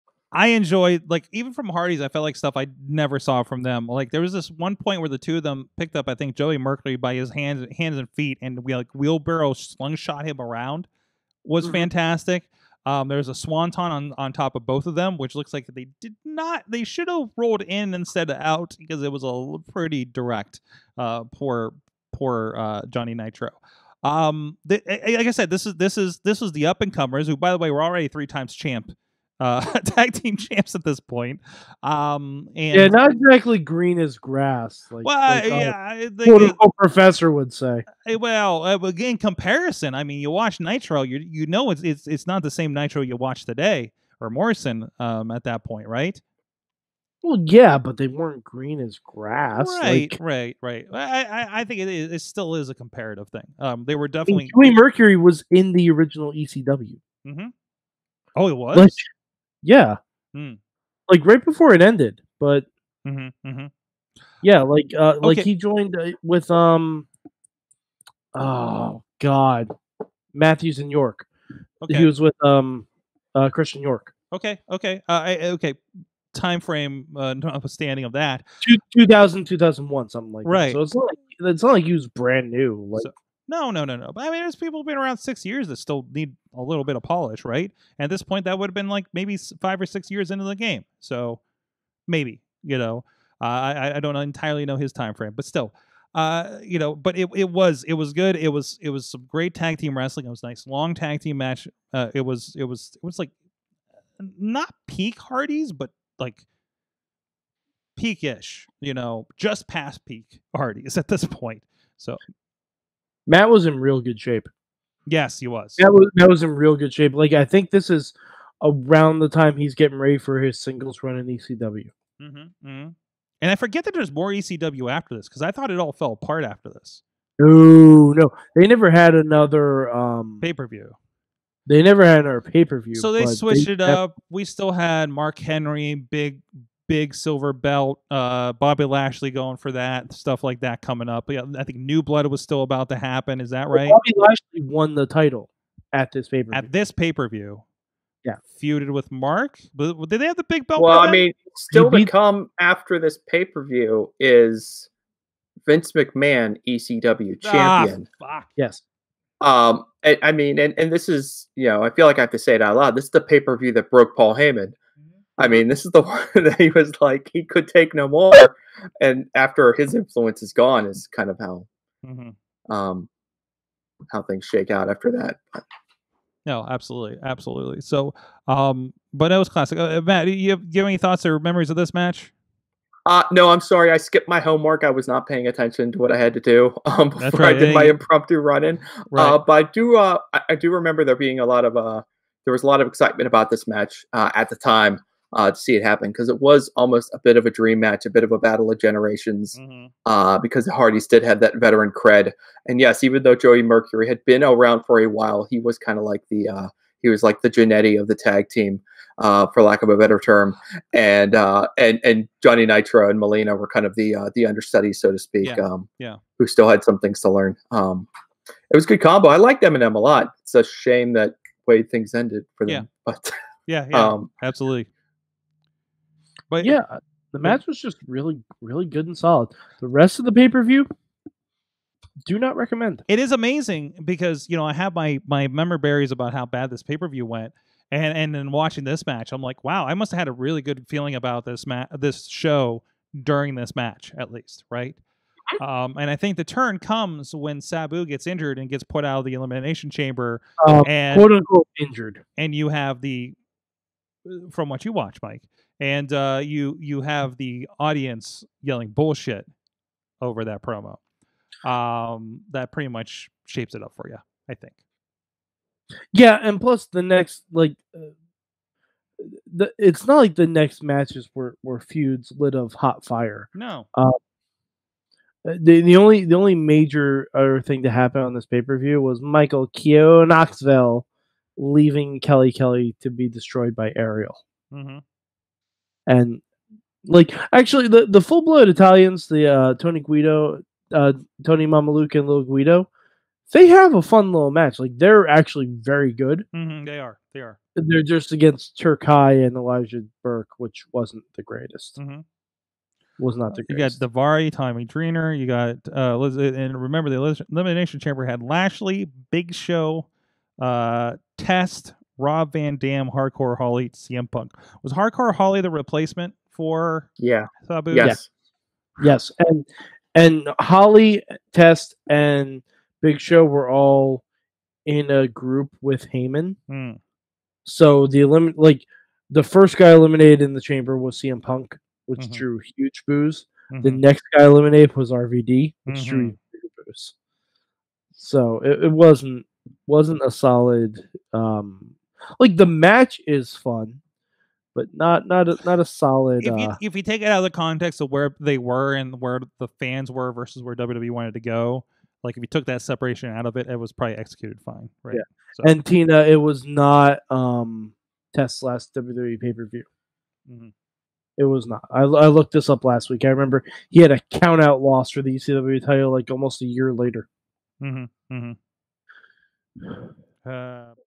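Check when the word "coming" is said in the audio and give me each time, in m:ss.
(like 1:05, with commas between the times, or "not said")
2:20.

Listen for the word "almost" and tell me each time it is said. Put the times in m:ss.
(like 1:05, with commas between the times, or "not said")
3:16, 6:06.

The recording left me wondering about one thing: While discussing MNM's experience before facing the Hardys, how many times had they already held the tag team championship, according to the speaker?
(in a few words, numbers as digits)
3.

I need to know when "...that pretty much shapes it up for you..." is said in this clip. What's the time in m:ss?
4:22.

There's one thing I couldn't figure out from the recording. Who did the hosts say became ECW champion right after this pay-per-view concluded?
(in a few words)
Vince McMahon.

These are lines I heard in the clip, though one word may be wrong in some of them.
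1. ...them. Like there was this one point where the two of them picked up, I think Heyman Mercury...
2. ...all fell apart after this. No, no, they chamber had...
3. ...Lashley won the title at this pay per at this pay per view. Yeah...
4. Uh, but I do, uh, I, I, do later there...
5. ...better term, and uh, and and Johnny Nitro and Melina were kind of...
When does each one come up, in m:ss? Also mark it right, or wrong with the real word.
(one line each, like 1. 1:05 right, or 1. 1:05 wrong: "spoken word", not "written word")
1. 0:03 wrong: "Joey", not "Heyman"
2. 2:05 wrong: "never", not "chamber"
3. 2:24 right
4. 3:09 wrong: "remember", not "later"
5. 3:29 right.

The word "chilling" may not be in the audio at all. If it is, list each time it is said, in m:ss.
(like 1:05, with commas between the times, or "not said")
not said.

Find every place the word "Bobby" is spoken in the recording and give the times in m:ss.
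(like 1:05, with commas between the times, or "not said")
2:18, 2:24.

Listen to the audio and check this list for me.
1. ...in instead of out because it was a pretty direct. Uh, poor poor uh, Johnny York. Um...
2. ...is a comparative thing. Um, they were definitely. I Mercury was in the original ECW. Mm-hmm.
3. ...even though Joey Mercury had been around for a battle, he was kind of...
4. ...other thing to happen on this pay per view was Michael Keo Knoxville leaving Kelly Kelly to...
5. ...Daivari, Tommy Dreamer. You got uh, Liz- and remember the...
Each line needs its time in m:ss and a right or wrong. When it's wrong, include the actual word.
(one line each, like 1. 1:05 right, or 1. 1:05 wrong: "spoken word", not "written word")
1. 0:17 wrong: "Nitro", not "York"
2. 0:52 right
3. 3:23 wrong: "while", not "battle"
4. 4:37 right
5. 5:04 right.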